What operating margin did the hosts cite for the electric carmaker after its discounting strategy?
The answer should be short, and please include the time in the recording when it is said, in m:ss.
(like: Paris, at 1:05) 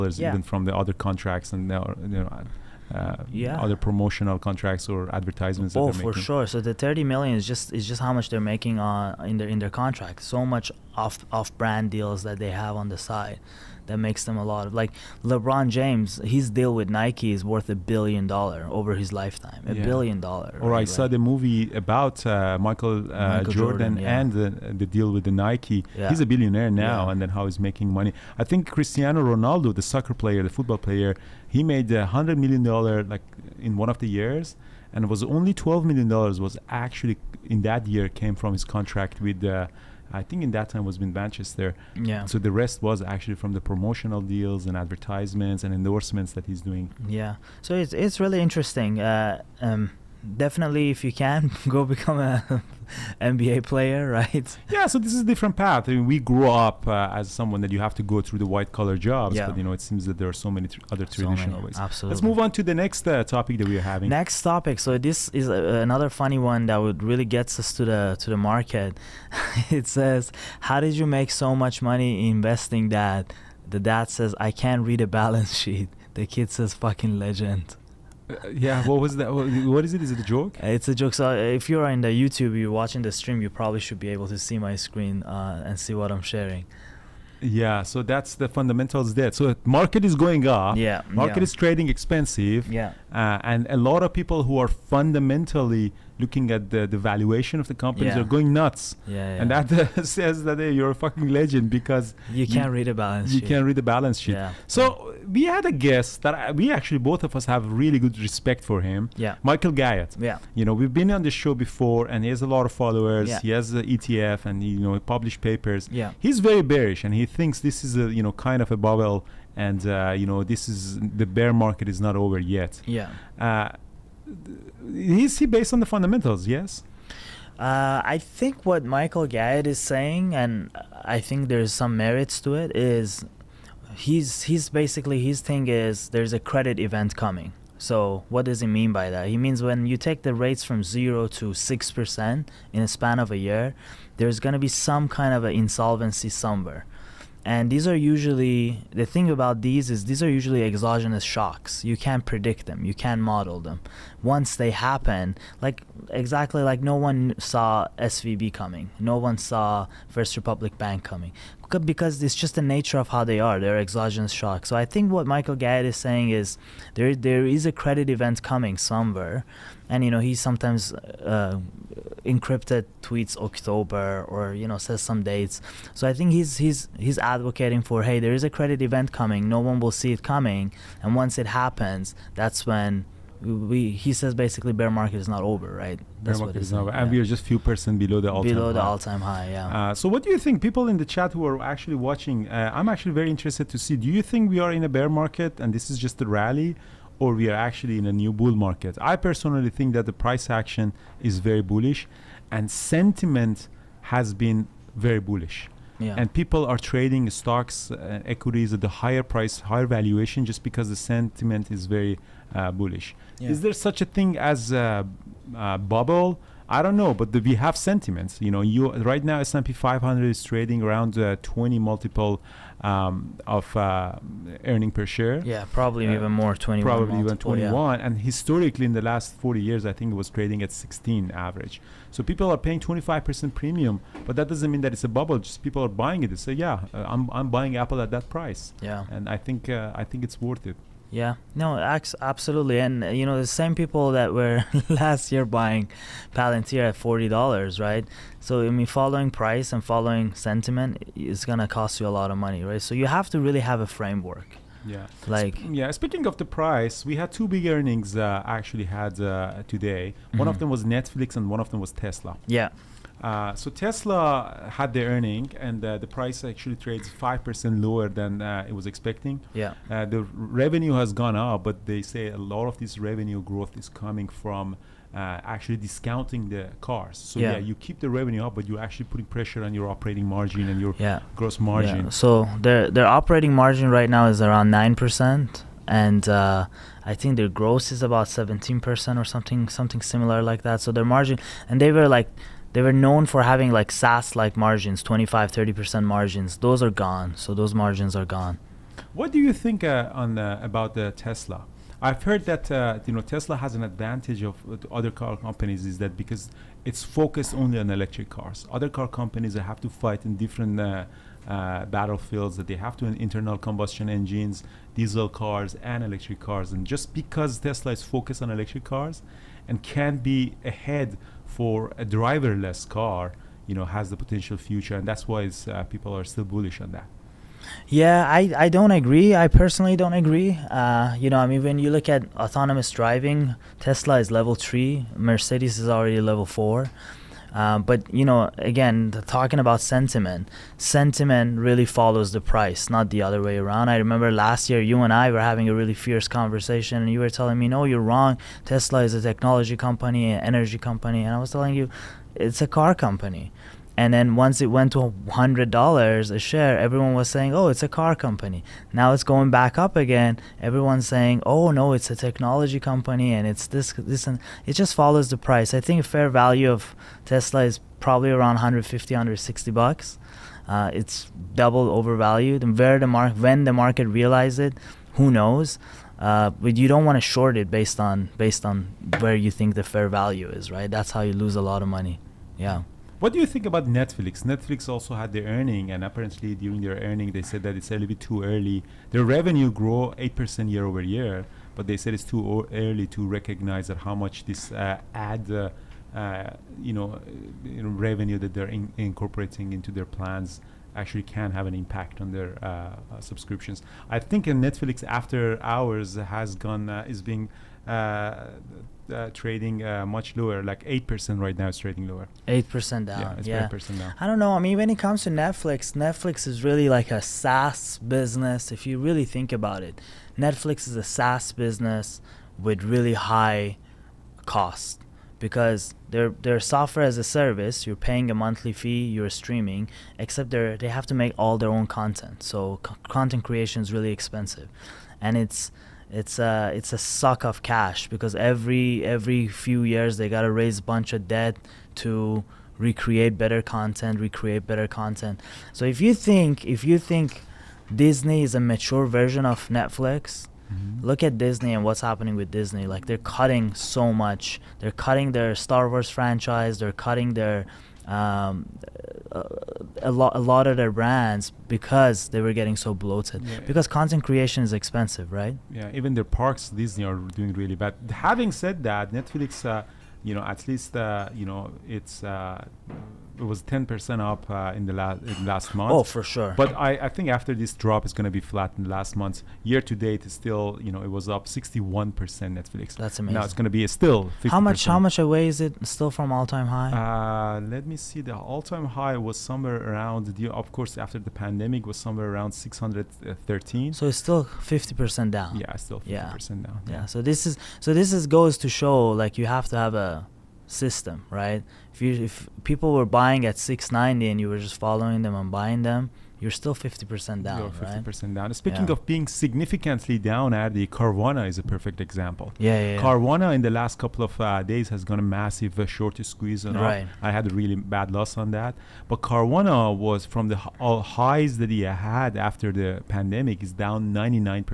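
9%, at 4:44.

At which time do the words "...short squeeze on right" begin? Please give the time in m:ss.
8:35.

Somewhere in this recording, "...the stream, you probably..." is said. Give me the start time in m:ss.
1:23.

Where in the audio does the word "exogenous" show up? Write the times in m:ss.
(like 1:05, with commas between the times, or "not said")
2:30, 2:43.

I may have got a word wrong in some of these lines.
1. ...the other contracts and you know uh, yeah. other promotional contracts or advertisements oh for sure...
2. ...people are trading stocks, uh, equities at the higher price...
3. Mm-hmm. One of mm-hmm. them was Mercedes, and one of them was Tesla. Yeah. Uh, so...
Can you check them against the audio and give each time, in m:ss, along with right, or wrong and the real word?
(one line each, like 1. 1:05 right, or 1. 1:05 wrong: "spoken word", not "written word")
1. 0:00 right
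2. 3:26 right
3. 4:20 wrong: "Netflix", not "Mercedes".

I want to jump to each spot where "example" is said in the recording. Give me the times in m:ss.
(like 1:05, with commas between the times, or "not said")
8:31.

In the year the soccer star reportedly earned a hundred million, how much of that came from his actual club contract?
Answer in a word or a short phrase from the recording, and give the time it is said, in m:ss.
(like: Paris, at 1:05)
12 million dollars, at 0:35.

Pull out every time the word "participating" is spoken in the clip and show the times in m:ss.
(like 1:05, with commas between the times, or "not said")
not said.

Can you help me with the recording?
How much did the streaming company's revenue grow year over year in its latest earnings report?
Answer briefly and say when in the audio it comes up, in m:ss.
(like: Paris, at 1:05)
8%, at 6:30.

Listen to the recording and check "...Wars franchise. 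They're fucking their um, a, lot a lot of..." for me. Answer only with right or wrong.
wrong.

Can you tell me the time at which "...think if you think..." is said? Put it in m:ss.
7:26.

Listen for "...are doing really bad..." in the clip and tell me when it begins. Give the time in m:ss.
7:47.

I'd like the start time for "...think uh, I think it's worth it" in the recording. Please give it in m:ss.
3:59.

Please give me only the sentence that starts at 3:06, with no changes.
That's bear market is not over, yeah.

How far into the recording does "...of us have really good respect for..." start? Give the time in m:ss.
1:47.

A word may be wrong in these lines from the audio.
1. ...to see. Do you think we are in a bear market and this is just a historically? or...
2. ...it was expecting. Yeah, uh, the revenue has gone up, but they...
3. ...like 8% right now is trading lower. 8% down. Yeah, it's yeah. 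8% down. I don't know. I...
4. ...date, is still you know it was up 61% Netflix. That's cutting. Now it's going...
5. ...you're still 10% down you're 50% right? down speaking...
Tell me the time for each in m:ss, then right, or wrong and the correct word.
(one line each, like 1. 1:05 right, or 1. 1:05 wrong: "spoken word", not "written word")
1. 3:13 wrong: "rally", not "historically"
2. 4:28 right
3. 6:50 right
4. 7:59 wrong: "amazing", not "cutting"
5. 8:26 wrong: "50", not "10".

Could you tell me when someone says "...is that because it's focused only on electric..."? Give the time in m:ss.
5:05.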